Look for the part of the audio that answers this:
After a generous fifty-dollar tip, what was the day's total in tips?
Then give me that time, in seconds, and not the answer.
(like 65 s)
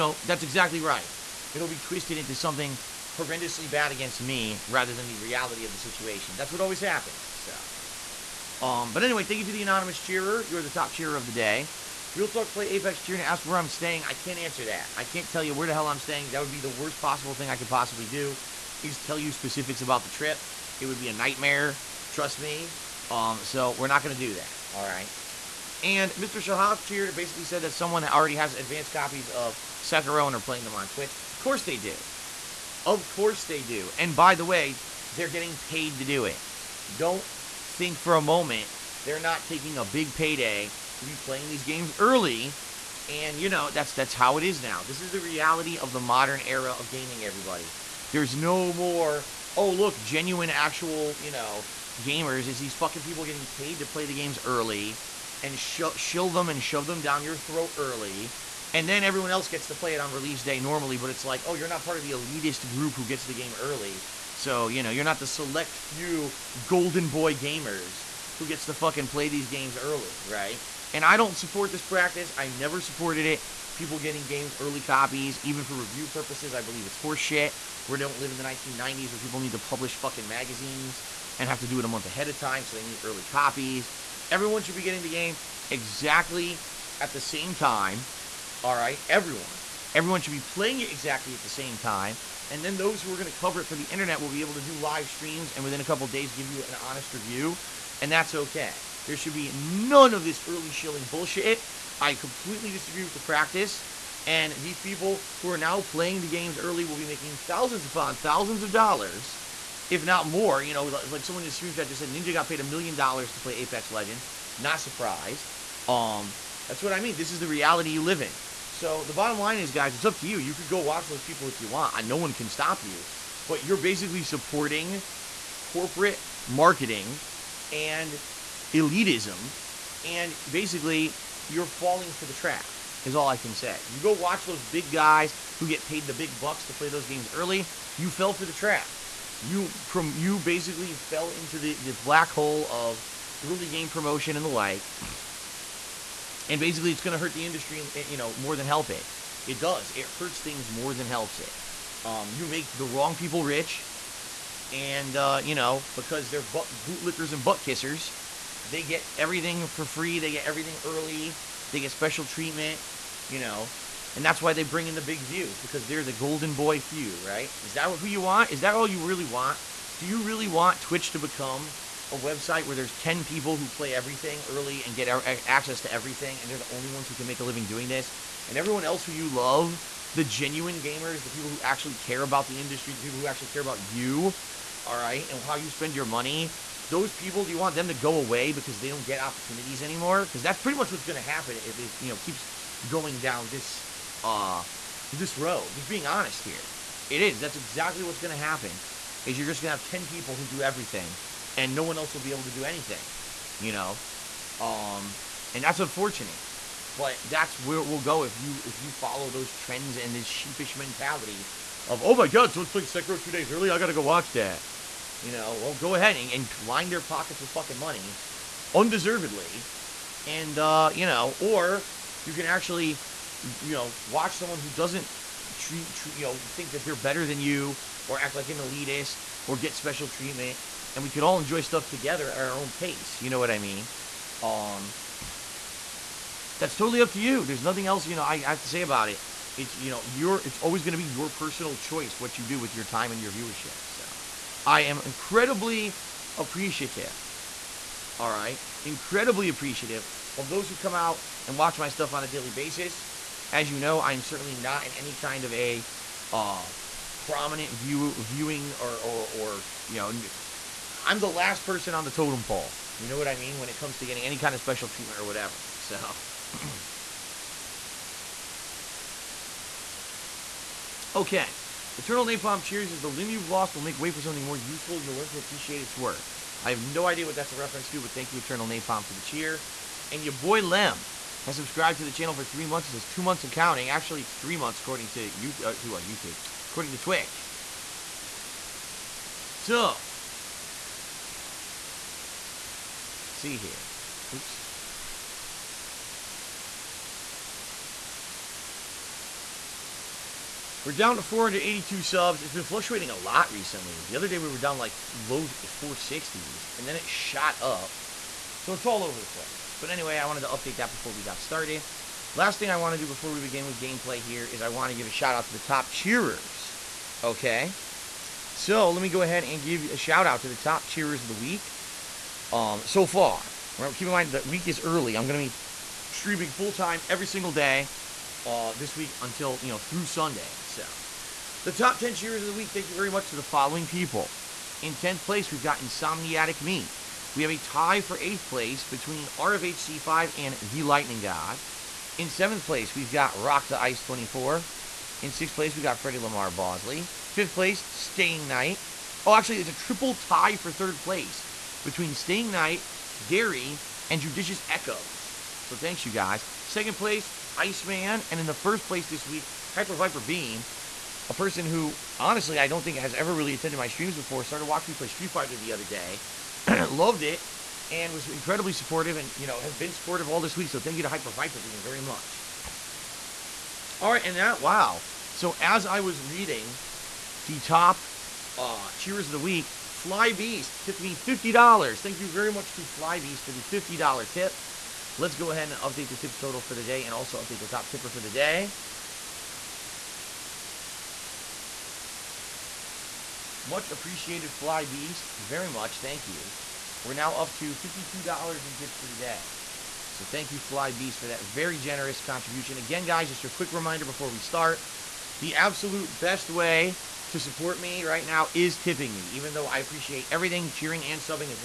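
397 s.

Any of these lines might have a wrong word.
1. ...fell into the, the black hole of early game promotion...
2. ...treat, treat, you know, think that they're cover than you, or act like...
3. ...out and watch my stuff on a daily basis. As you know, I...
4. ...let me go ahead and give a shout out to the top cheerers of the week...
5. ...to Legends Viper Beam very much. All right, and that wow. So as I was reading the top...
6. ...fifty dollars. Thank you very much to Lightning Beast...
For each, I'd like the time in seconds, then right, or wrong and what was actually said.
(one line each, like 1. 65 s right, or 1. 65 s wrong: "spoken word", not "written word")
1. 140 s right
2. 225 s wrong: "better", not "cover"
3. 250 s right
4. 318 s right
5. 371 s wrong: "Hyper", not "Legends"
6. 381 s wrong: "Fly", not "Lightning".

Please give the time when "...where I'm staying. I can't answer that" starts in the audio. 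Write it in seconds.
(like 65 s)
13 s.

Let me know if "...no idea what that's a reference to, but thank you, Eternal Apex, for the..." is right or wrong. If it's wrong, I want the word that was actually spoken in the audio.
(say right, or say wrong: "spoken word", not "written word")
wrong: "Napalm", not "Apex".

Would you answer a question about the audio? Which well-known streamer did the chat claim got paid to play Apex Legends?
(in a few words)
Ninja.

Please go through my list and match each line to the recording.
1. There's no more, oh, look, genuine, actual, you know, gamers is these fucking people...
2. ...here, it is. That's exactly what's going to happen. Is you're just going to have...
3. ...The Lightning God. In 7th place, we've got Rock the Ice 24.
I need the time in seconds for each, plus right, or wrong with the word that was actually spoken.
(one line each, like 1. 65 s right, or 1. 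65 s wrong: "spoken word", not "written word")
1. 48 s right
2. 196 s right
3. 340 s right.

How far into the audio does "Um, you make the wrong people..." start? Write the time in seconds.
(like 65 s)
152 s.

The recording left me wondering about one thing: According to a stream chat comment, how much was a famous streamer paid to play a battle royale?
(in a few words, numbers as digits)
a million dollars.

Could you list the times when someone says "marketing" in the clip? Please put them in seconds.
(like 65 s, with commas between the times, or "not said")
126 s.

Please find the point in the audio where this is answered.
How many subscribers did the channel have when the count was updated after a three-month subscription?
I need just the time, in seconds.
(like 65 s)
301 s.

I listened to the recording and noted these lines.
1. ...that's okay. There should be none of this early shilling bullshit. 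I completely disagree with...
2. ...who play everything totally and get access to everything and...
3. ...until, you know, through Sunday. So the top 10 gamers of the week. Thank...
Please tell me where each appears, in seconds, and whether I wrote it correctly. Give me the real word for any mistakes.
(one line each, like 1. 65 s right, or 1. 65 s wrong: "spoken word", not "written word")
1. 98 s right
2. 173 s wrong: "early", not "totally"
3. 329 s wrong: "cheers", not "gamers".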